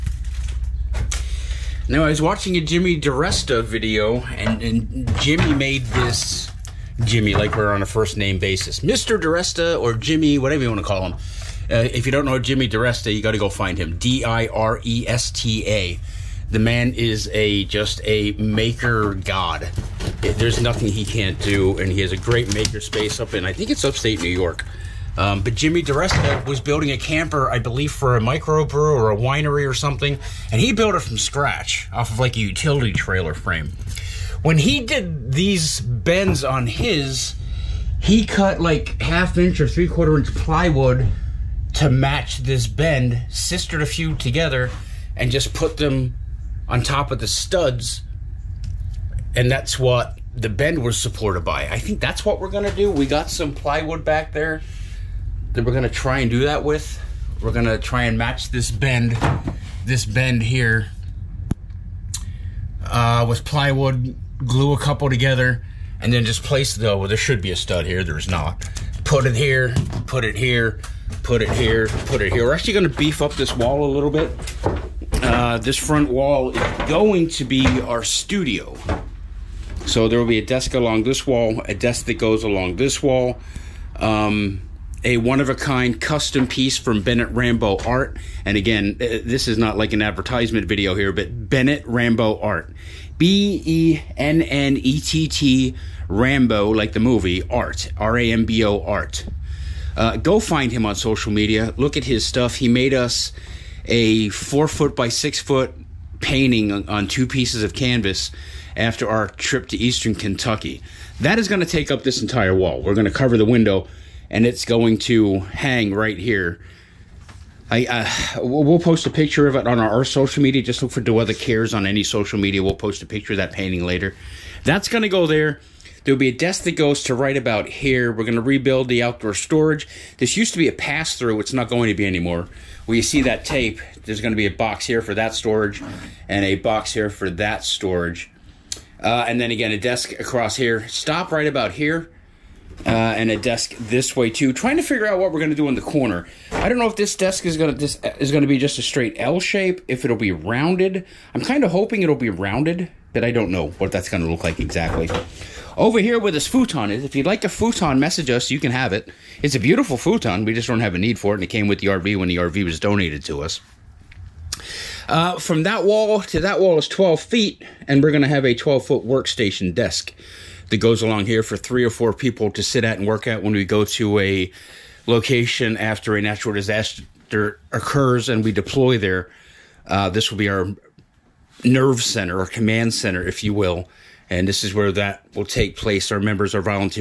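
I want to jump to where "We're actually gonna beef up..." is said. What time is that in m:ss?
1:12.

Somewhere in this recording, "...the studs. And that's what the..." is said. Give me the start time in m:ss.
0:47.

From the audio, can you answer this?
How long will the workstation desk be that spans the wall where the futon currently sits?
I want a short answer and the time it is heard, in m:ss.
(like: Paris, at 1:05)
12 feet, at 2:48.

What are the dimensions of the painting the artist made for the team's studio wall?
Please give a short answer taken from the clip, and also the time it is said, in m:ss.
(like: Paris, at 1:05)
4 feet by 6 feet, at 1:44.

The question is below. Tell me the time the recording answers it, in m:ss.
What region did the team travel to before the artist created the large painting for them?
1:49.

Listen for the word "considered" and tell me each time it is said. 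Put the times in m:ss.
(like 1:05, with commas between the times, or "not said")
not said.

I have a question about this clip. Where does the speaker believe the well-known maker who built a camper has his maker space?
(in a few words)
Upstate New York.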